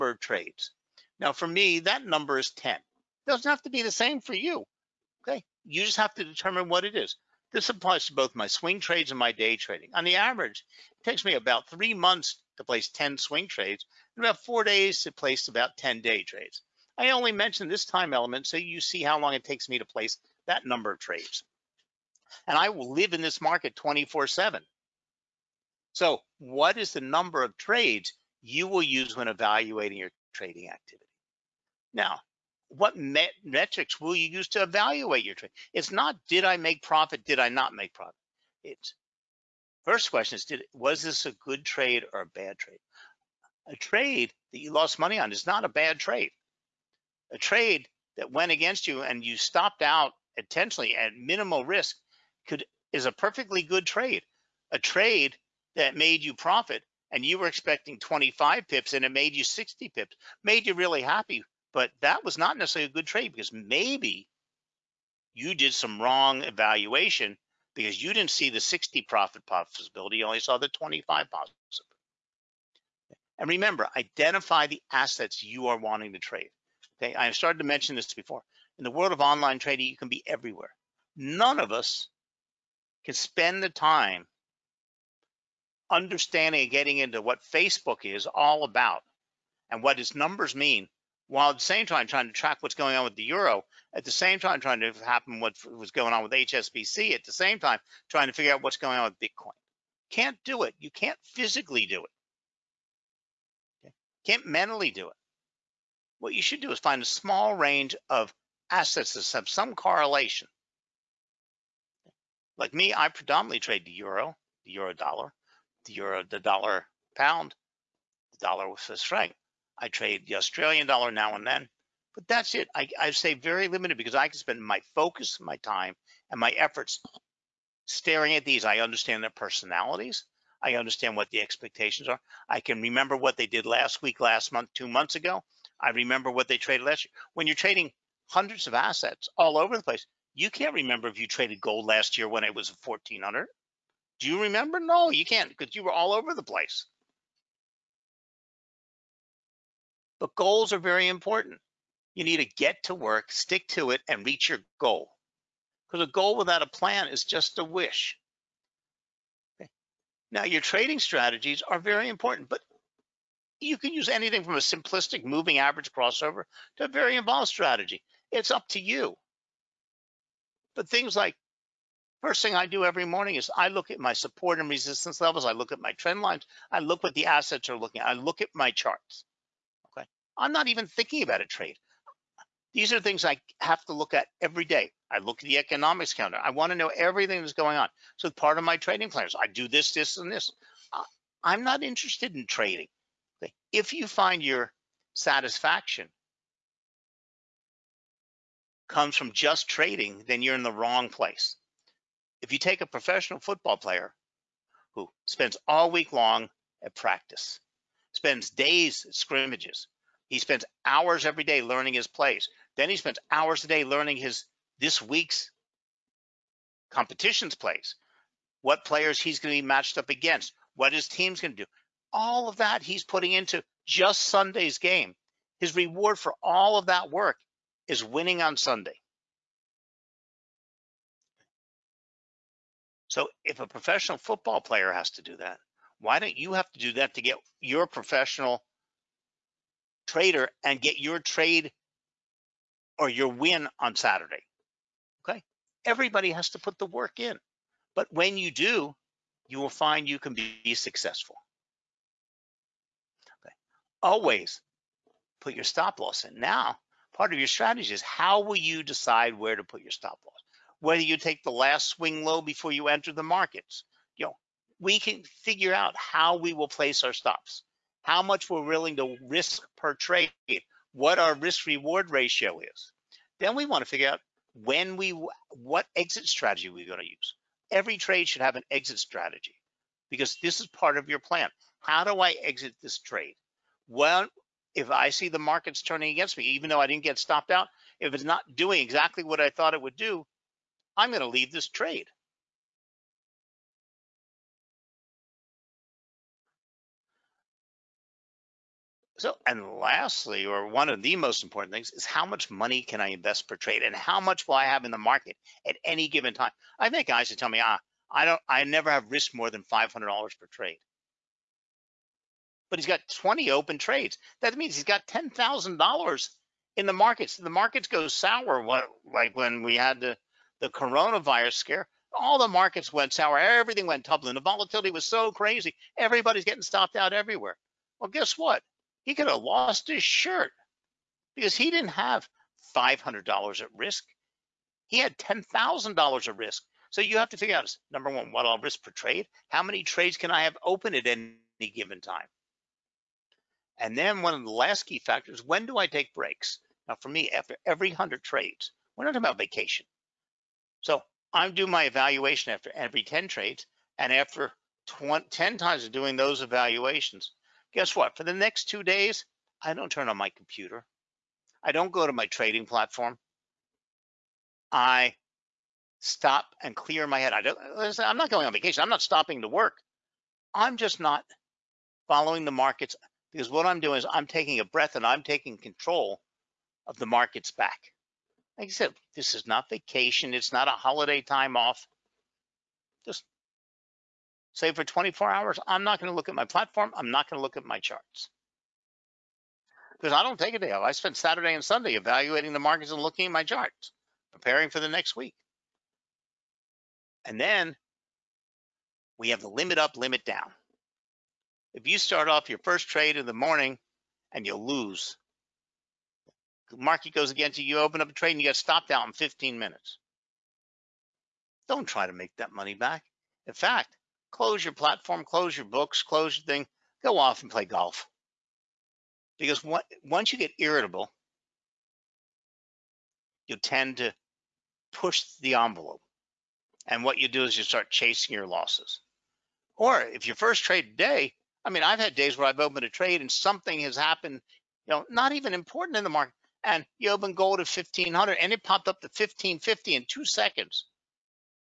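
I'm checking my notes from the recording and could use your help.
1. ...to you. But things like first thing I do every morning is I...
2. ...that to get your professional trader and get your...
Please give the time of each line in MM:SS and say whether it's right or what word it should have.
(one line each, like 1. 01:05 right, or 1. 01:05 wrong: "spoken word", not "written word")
1. 02:48 right
2. 03:56 right.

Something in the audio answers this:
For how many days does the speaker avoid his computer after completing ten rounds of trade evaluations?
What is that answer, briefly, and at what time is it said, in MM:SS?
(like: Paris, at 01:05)
2, at 05:58.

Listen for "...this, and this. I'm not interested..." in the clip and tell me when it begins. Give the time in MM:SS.
03:09.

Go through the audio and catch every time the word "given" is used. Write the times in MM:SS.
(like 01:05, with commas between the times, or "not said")
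05:06, 05:41.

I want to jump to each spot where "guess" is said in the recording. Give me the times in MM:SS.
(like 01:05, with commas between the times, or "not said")
05:28, 05:57.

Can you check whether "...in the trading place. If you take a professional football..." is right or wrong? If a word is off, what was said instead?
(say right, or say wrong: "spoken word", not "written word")
wrong: "wrong", not "trading".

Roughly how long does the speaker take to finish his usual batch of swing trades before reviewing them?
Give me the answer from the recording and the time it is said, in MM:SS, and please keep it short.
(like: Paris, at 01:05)
3 months, at 00:11.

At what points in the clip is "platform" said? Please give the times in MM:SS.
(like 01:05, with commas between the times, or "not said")
06:02, 06:26, 06:54.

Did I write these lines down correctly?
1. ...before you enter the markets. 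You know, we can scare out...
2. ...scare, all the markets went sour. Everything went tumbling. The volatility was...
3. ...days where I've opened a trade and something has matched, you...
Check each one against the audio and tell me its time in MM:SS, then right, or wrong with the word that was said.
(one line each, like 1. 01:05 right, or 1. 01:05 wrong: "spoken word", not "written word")
1. 04:22 wrong: "figure", not "scare"
2. 05:21 right
3. 07:12 wrong: "happened", not "matched".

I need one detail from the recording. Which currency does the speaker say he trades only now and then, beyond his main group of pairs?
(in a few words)
Australian dollar.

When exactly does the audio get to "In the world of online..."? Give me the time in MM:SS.
01:18.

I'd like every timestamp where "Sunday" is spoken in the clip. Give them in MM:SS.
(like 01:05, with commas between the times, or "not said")
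03:44, 03:48, 06:31.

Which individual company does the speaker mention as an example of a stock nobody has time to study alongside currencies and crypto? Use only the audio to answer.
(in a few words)
HSBC.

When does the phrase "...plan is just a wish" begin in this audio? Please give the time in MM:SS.
02:36.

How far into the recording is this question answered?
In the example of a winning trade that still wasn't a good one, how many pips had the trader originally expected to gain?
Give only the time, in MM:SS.
00:57.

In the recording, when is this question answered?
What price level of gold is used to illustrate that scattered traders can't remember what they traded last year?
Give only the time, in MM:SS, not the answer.
02:22.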